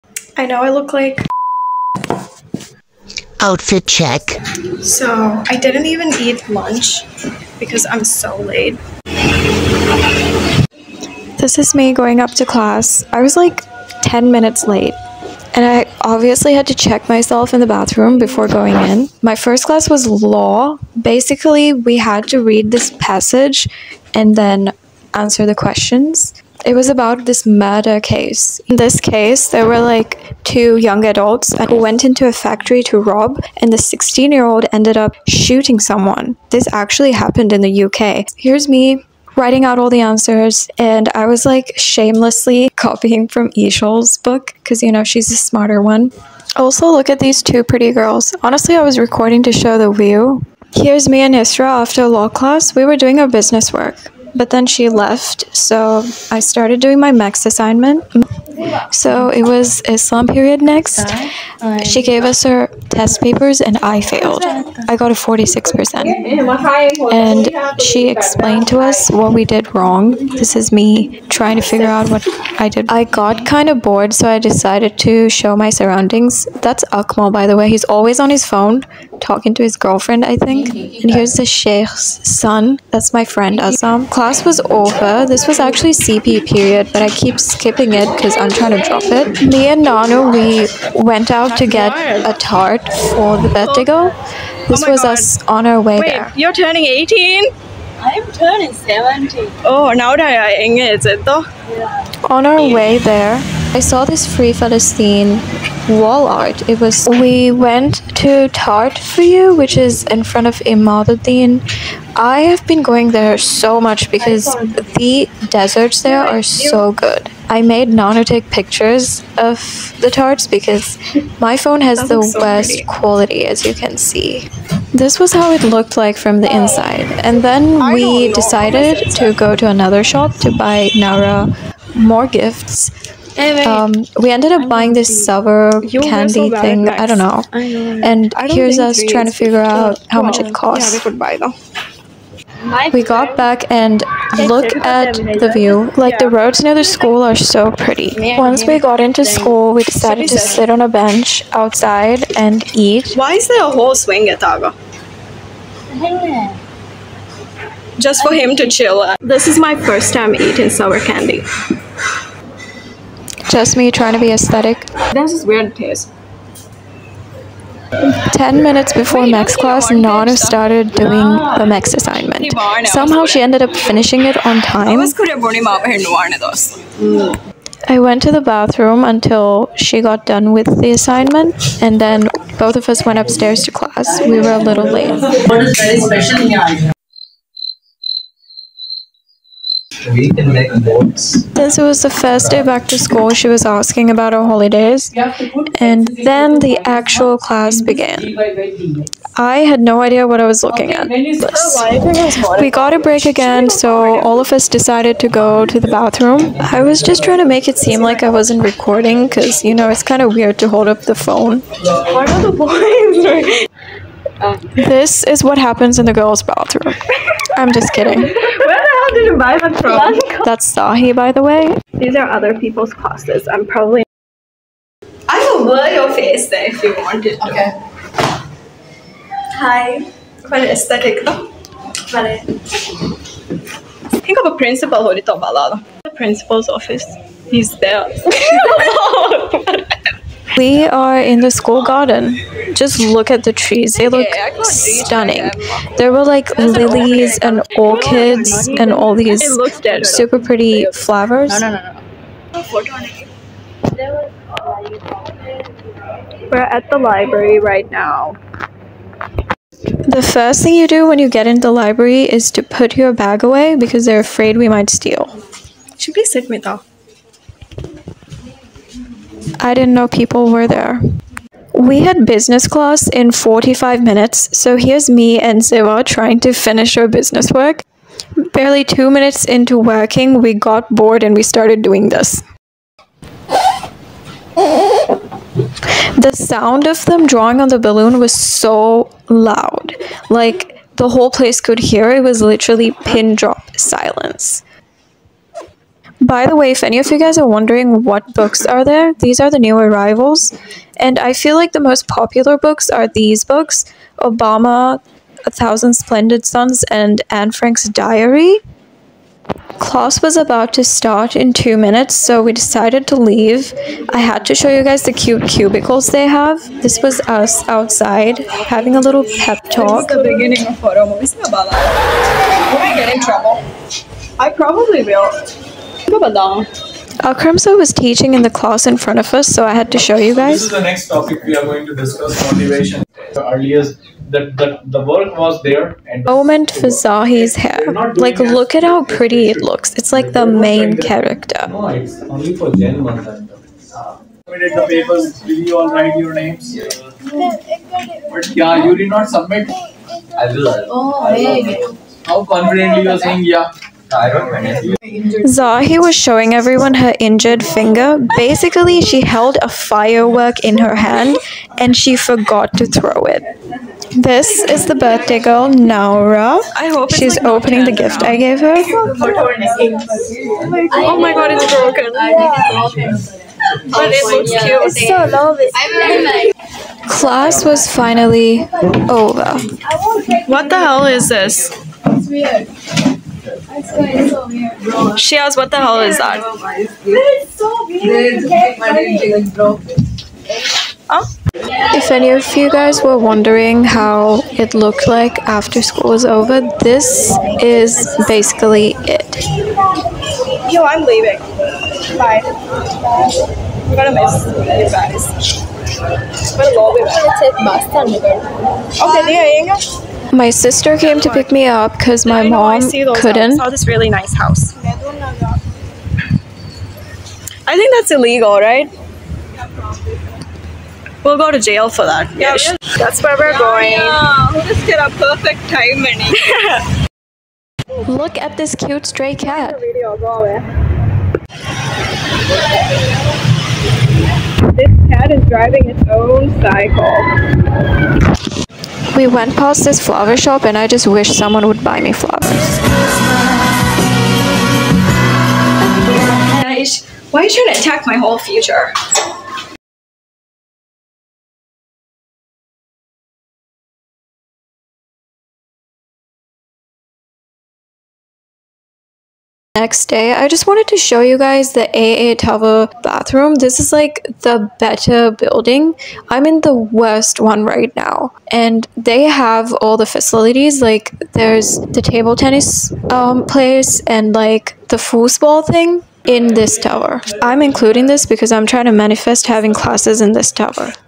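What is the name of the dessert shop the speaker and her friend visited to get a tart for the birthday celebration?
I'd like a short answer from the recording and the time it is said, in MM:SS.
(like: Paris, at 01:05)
Tart for you, at 01:48.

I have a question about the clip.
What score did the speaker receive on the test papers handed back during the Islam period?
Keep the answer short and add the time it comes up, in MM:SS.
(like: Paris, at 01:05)
46%, at 01:05.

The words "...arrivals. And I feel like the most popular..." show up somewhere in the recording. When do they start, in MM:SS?
04:59.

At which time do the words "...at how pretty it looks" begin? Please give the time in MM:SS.
05:38.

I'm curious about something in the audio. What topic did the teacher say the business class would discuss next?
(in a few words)
Motivation.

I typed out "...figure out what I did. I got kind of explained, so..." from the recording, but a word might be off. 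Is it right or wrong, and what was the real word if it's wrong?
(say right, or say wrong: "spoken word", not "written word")
wrong: "bored", not "explained".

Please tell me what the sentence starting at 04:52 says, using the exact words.
It was literally pin drop silence.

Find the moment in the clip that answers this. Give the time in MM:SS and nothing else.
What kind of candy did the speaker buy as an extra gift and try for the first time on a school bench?
02:40.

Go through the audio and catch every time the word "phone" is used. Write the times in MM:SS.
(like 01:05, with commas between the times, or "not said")
01:18, 02:01, 03:31.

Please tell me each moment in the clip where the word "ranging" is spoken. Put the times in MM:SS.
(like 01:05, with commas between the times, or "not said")
not said.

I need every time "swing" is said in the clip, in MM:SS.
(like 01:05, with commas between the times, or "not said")
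02:33.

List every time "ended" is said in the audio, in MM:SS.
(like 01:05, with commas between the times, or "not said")
00:34, 02:14, 02:53.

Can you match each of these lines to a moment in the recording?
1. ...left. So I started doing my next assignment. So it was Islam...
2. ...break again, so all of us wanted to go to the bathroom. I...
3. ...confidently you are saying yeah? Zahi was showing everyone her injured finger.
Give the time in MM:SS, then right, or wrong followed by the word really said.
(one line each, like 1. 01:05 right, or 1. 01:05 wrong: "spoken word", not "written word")
1. 00:54 right
2. 03:22 wrong: "decided", not "wanted"
3. 05:52 right.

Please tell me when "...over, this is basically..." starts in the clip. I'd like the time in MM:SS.
06:36.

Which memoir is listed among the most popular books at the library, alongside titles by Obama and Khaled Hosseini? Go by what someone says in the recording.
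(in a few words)
Anne Frank's Diary.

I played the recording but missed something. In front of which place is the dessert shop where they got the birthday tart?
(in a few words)
Imaduddin.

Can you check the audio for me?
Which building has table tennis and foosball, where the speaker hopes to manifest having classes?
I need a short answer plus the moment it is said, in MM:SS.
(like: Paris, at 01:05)
AA Tower, at 07:41.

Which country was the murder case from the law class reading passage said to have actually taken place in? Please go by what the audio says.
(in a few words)
UK.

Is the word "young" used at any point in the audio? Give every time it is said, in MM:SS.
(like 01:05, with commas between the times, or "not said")
00:30.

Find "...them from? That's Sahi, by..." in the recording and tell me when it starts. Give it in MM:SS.
03:39.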